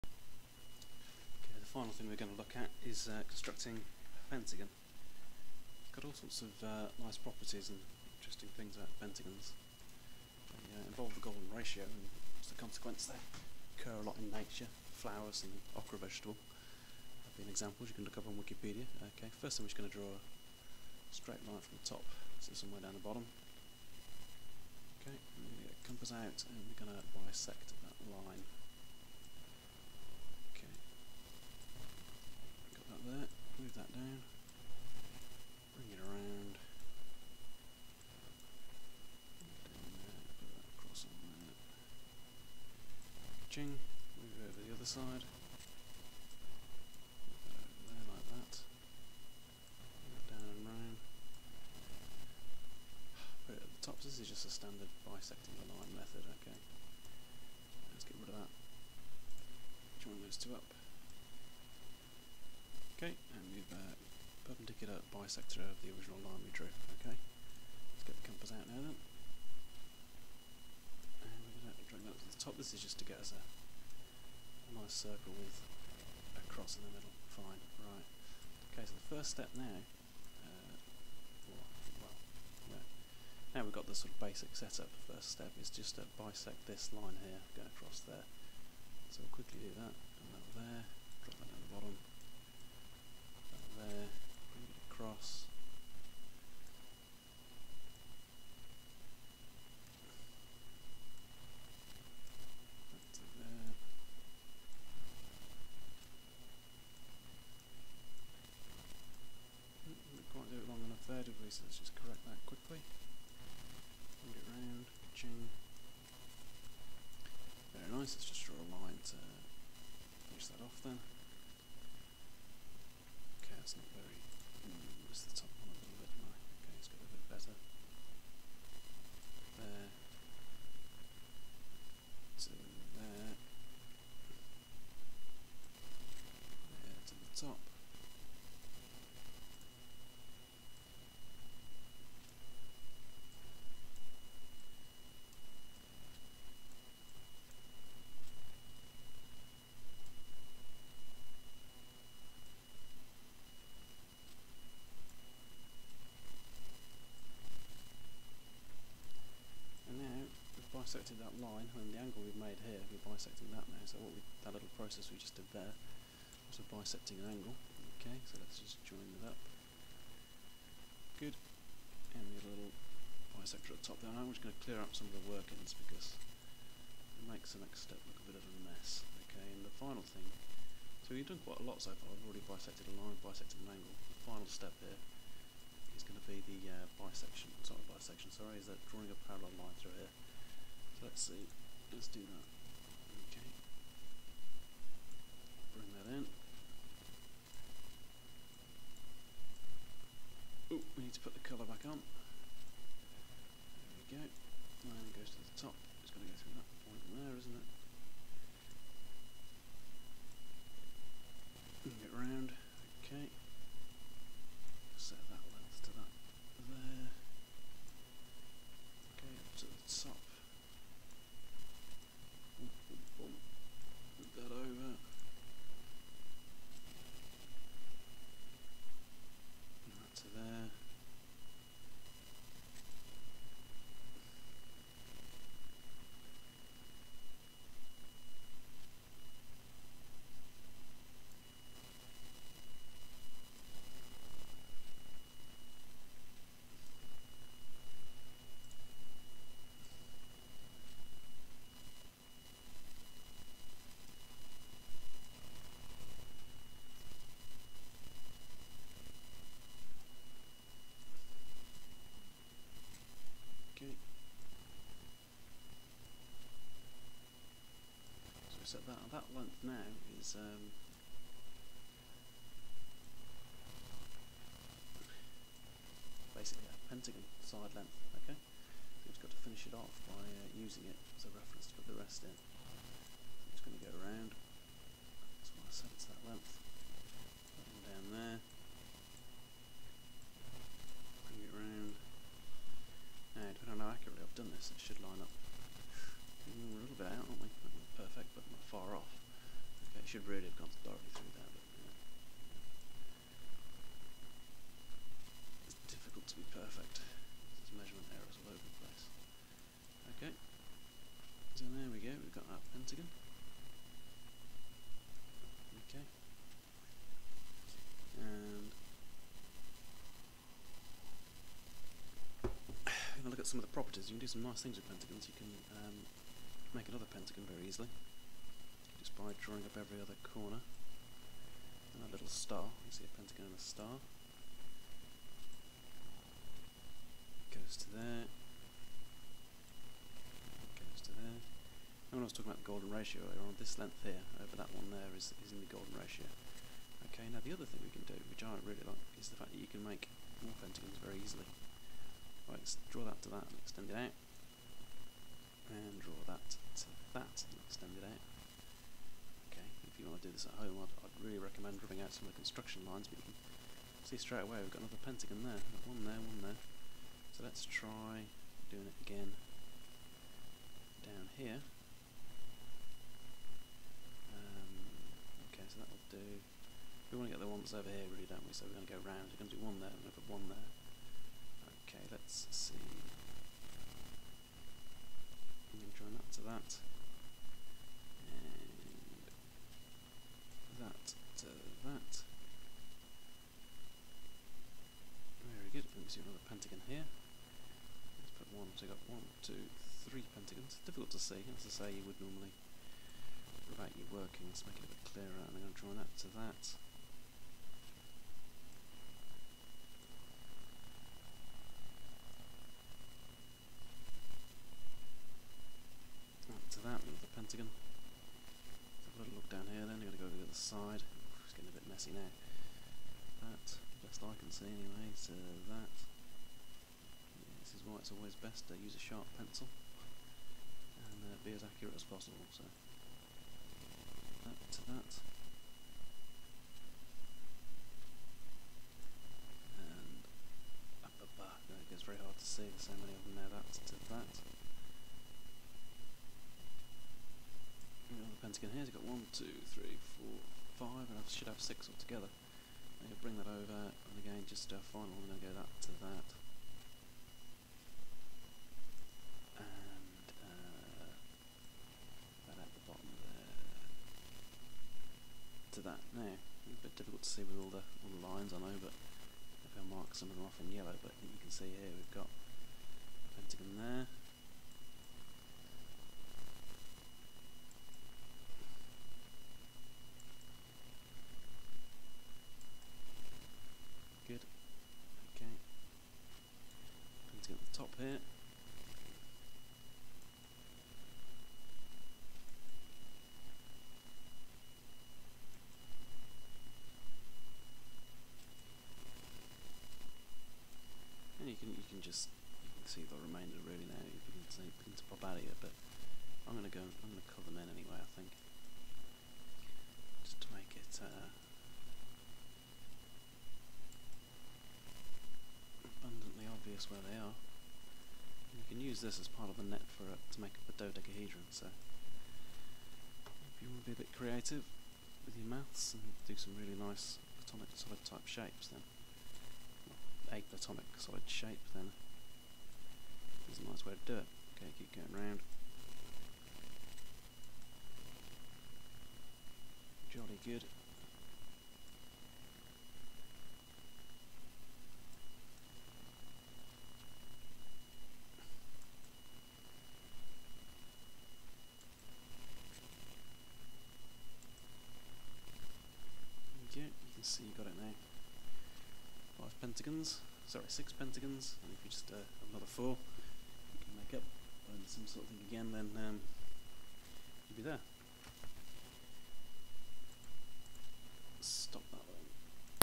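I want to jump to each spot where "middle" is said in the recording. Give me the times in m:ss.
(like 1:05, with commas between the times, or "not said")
1:16.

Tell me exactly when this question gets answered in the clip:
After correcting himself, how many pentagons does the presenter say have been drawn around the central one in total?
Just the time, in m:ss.
9:20.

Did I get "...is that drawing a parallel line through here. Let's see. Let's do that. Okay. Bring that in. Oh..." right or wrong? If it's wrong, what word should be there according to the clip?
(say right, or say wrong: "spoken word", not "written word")
right.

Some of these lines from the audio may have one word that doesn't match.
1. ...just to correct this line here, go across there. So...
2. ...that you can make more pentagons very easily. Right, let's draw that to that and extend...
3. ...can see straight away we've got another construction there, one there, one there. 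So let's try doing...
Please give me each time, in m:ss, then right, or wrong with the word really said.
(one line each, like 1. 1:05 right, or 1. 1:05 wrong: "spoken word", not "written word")
1. 1:25 wrong: "bisect", not "correct"
2. 5:49 right
3. 6:03 wrong: "pentagon", not "construction".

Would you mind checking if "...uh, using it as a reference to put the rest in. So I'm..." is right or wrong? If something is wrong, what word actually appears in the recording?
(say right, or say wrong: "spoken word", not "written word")
right.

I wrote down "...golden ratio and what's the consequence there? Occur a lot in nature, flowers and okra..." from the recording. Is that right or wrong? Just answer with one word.
right.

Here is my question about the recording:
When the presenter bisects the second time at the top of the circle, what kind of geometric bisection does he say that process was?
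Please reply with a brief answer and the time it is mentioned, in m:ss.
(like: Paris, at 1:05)
Bisecting an angle, at 2:46.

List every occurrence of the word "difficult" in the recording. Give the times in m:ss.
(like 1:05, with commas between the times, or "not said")
6:40, 7:46.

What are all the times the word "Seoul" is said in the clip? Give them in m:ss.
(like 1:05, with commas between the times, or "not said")
not said.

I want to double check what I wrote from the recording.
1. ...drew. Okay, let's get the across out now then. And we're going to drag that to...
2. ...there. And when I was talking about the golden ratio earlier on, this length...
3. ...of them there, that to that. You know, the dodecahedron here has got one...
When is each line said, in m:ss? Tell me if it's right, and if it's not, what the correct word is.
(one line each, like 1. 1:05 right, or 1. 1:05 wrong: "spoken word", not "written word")
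1. 1:06 wrong: "compass", not "across"
2. 5:41 right
3. 7:23 wrong: "pentagon", not "dodecahedron".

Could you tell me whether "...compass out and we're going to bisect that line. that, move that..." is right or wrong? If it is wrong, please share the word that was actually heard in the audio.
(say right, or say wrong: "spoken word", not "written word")
right.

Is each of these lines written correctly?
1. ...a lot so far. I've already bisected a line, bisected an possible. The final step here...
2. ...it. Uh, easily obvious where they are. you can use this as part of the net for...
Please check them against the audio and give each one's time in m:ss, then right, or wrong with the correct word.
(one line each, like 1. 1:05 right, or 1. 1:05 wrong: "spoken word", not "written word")
1. 3:01 wrong: "angle", not "possible"
2. 8:30 wrong: "abundantly", not "easily".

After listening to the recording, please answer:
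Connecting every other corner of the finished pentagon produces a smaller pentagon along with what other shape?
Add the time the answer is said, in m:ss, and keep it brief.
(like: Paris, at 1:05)
A star, at 5:32.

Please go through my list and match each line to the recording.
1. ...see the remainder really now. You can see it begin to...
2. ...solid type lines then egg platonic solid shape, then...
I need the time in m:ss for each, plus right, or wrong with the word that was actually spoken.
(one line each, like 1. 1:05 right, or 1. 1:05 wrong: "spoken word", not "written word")
1. 8:22 right
2. 8:47 wrong: "shapes", not "lines".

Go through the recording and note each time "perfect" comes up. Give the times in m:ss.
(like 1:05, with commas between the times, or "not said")
5:06.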